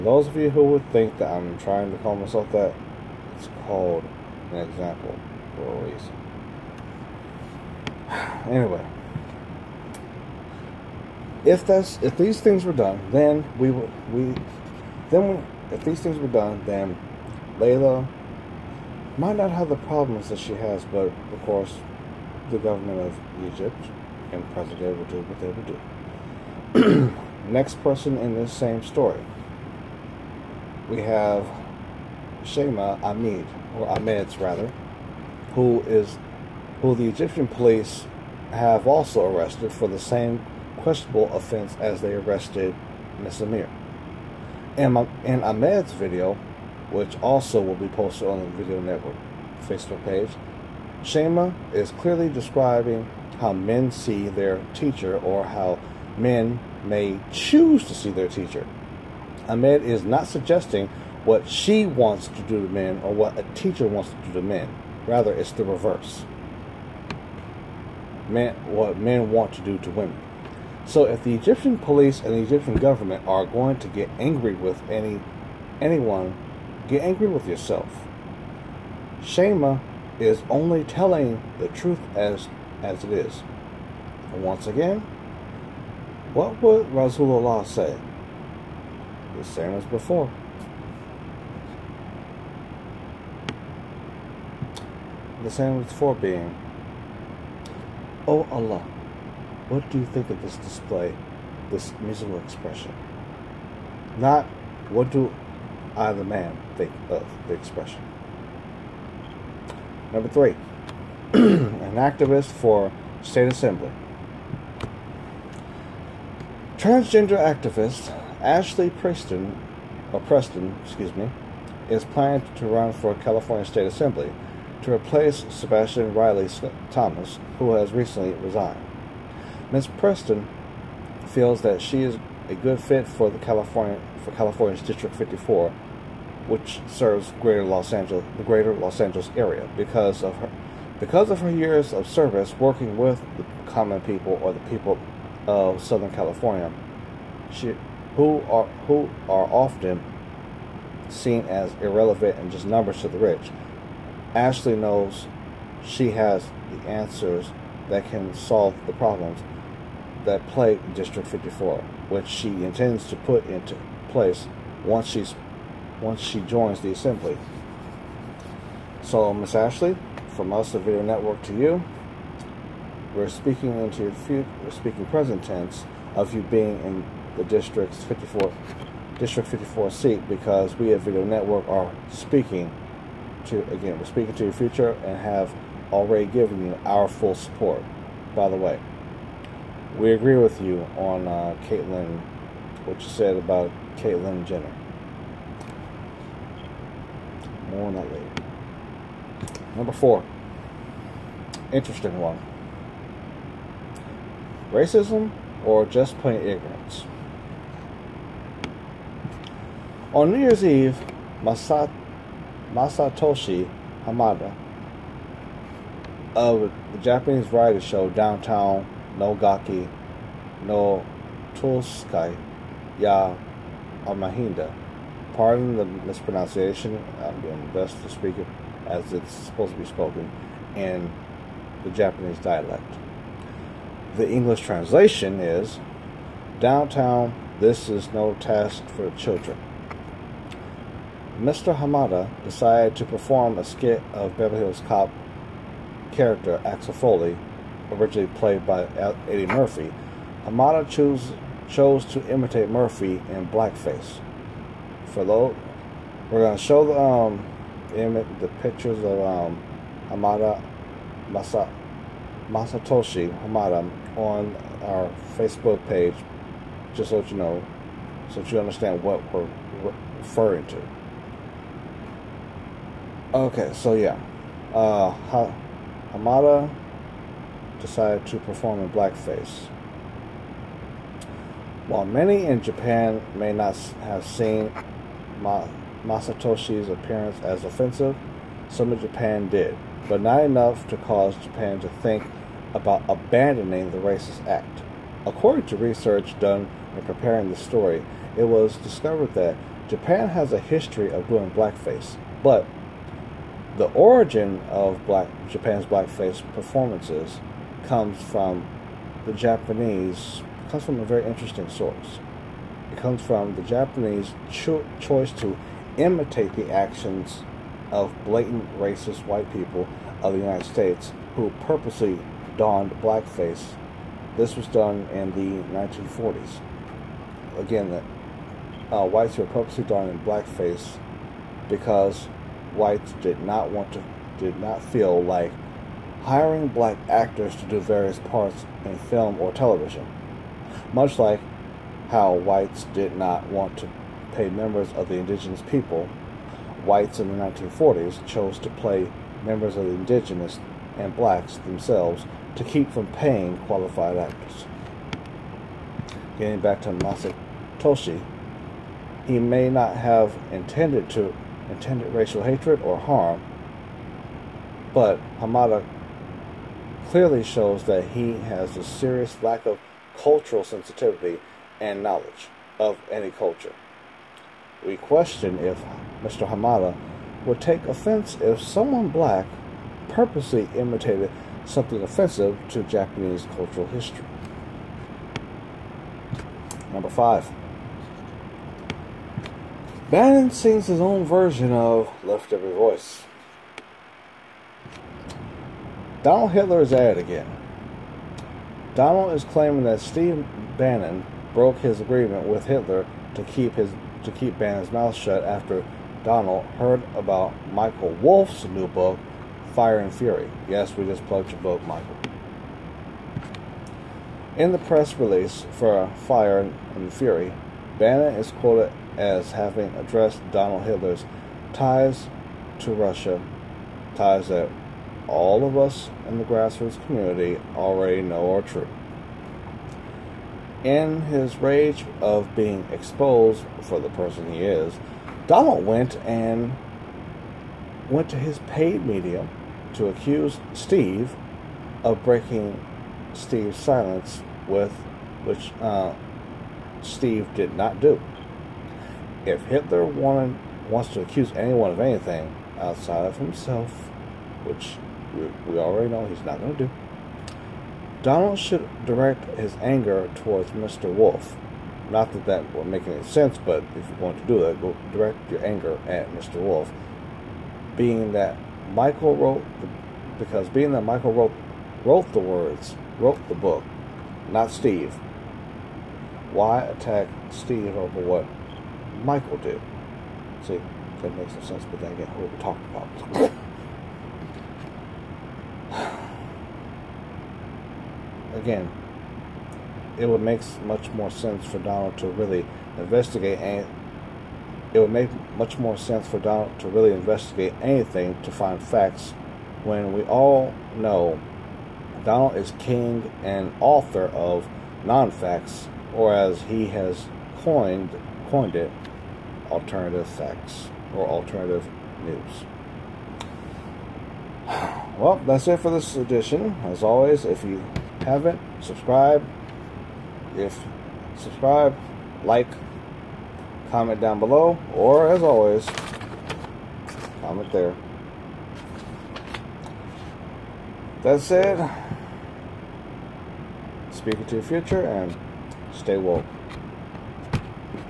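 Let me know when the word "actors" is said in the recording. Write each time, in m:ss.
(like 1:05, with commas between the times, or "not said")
5:37, 5:54.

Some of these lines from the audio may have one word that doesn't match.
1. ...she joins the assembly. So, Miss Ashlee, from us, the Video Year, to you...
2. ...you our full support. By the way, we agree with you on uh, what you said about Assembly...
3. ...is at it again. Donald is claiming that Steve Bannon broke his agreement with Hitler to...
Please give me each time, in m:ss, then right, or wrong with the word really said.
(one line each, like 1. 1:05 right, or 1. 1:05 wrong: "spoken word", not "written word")
1. 2:46 wrong: "Network", not "Year"
2. 3:06 wrong: "Caitlyn", not "Assembly"
3. 6:36 right.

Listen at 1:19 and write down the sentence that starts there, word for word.
Shema is only telling the truth as, as it is.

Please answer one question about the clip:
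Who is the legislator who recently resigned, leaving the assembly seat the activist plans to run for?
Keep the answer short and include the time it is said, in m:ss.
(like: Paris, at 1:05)
Sebastian Riley Thomas, at 2:05.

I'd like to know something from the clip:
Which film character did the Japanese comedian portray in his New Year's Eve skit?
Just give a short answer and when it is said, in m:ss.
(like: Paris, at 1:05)
Axel Foley, at 4:06.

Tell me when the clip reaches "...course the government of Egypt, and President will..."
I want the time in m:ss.
0:21.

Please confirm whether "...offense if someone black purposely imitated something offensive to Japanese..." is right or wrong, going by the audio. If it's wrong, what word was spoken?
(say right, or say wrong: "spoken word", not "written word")
right.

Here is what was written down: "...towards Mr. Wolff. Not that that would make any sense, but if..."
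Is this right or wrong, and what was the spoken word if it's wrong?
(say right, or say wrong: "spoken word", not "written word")
right.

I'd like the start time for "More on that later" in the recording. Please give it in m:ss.
3:17.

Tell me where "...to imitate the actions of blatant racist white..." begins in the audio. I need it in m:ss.
5:15.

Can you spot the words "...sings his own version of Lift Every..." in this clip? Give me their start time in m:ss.
6:30.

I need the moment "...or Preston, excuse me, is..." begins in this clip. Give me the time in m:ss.
2:00.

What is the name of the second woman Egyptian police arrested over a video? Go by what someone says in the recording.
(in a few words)
Shema Ahmed.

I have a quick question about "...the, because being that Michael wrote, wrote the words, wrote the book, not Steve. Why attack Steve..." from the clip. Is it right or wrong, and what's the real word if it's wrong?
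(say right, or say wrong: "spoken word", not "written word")
right.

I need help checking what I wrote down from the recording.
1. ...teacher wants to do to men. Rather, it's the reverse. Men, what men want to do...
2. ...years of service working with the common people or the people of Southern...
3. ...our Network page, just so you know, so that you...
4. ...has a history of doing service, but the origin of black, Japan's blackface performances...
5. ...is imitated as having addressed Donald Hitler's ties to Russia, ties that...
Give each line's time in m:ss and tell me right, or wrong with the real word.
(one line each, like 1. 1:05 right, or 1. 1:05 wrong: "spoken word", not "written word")
1. 1:03 right
2. 2:21 right
3. 4:24 wrong: "Facebook", not "Network"
4. 5:00 wrong: "blackface", not "service"
5. 6:58 wrong: "quoted", not "imitated".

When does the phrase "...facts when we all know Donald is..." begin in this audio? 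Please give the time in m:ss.
8:18.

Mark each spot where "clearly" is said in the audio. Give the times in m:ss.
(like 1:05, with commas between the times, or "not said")
0:51, 6:07.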